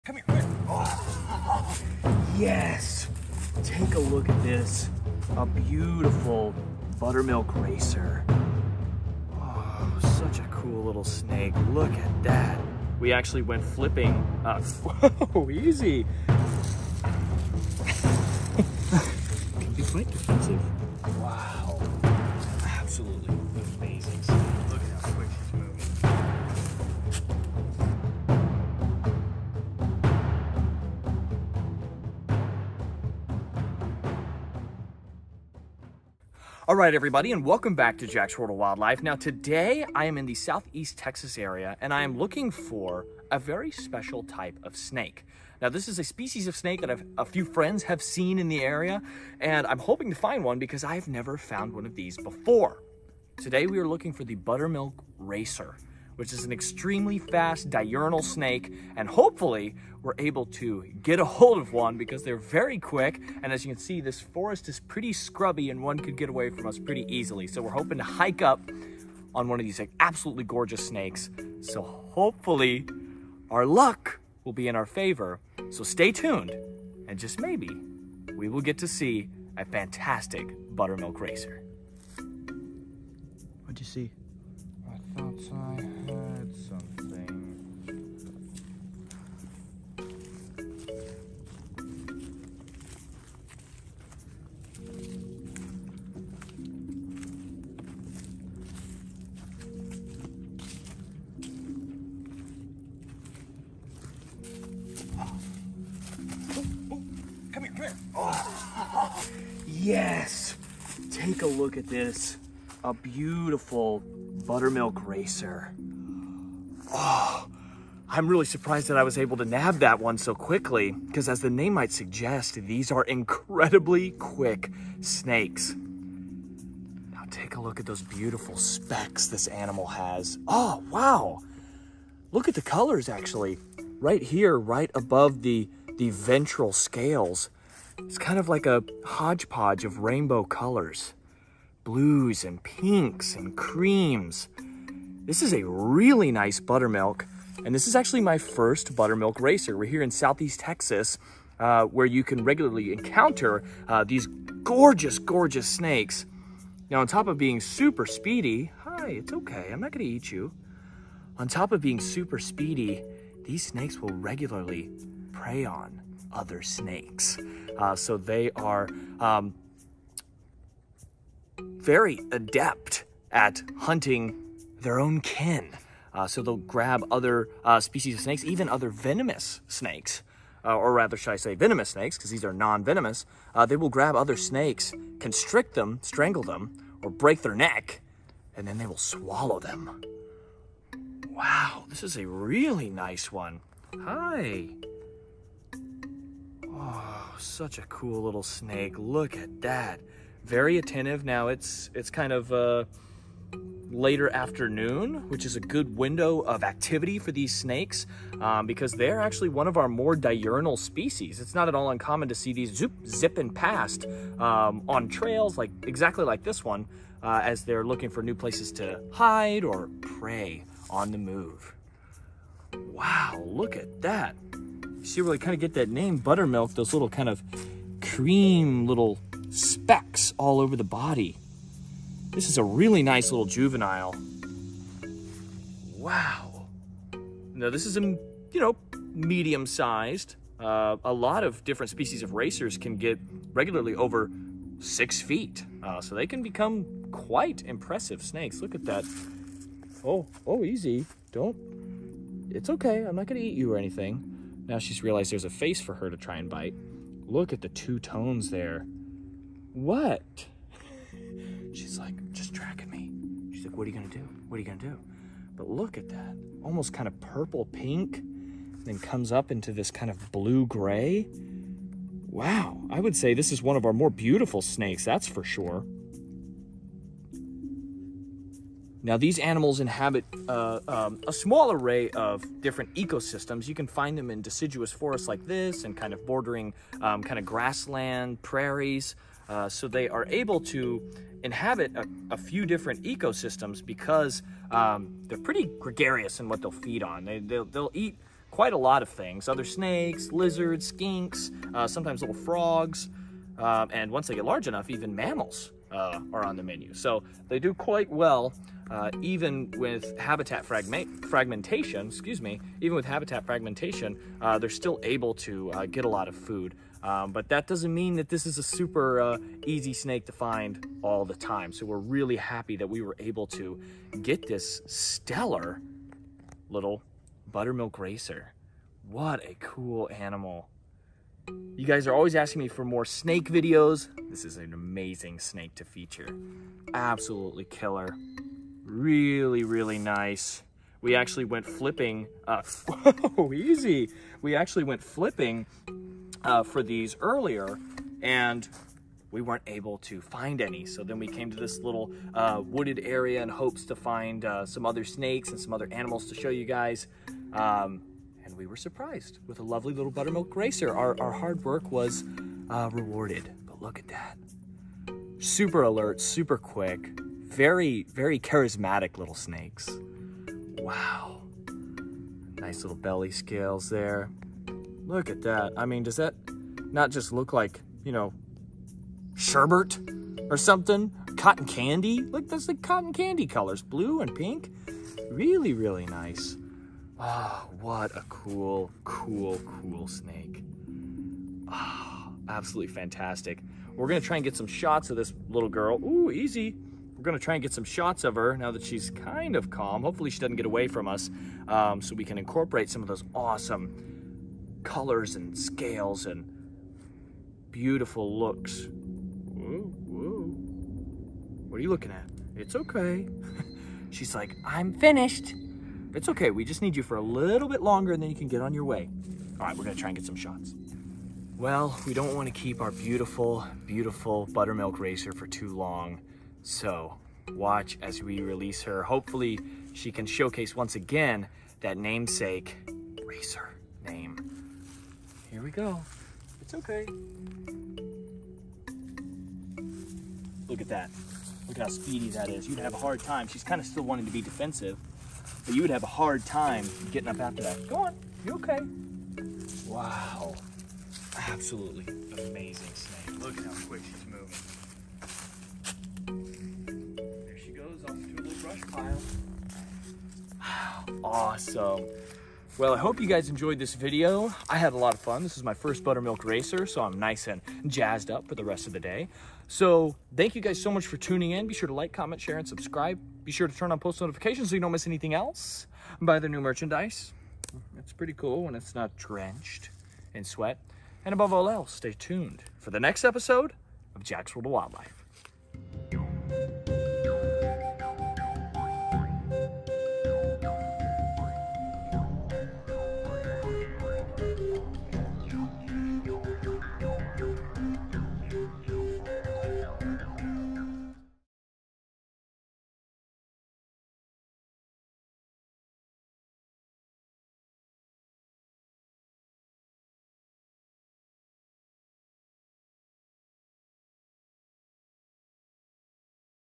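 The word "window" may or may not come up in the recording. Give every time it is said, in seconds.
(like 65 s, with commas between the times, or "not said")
205 s.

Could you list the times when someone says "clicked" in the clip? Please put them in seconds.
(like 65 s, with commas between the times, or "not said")
not said.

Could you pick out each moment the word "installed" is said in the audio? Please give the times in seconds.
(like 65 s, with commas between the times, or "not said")
not said.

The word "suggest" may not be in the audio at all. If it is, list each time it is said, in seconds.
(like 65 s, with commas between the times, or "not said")
121 s.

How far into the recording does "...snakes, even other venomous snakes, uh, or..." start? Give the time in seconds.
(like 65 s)
178 s.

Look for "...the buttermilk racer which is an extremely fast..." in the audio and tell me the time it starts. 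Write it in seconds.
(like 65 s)
54 s.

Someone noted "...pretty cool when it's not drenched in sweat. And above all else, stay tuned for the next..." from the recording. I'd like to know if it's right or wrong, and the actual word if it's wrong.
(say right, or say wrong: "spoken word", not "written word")
right.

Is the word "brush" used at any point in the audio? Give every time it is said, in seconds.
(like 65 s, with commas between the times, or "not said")
458 s.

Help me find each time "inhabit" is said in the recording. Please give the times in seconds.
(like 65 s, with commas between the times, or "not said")
279 s, 291 s.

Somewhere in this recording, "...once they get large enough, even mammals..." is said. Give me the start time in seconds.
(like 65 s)
304 s.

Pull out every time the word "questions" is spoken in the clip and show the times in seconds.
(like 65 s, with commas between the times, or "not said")
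not said.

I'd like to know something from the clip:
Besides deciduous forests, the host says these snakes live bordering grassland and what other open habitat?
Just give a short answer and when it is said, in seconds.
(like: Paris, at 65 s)
prairies, at 288 s.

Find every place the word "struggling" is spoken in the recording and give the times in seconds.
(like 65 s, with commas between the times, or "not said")
not said.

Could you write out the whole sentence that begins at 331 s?
You guys are always asking me for more snake videos.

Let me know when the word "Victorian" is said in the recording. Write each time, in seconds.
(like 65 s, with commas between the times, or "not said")
not said.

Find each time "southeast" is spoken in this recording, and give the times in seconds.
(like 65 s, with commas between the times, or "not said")
40 s, 150 s.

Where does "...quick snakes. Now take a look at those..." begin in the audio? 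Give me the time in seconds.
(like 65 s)
124 s.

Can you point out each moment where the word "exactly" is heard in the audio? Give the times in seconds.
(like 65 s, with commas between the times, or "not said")
215 s.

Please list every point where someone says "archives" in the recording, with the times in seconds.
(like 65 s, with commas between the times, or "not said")
not said.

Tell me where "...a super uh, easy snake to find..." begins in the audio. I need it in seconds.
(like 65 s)
318 s.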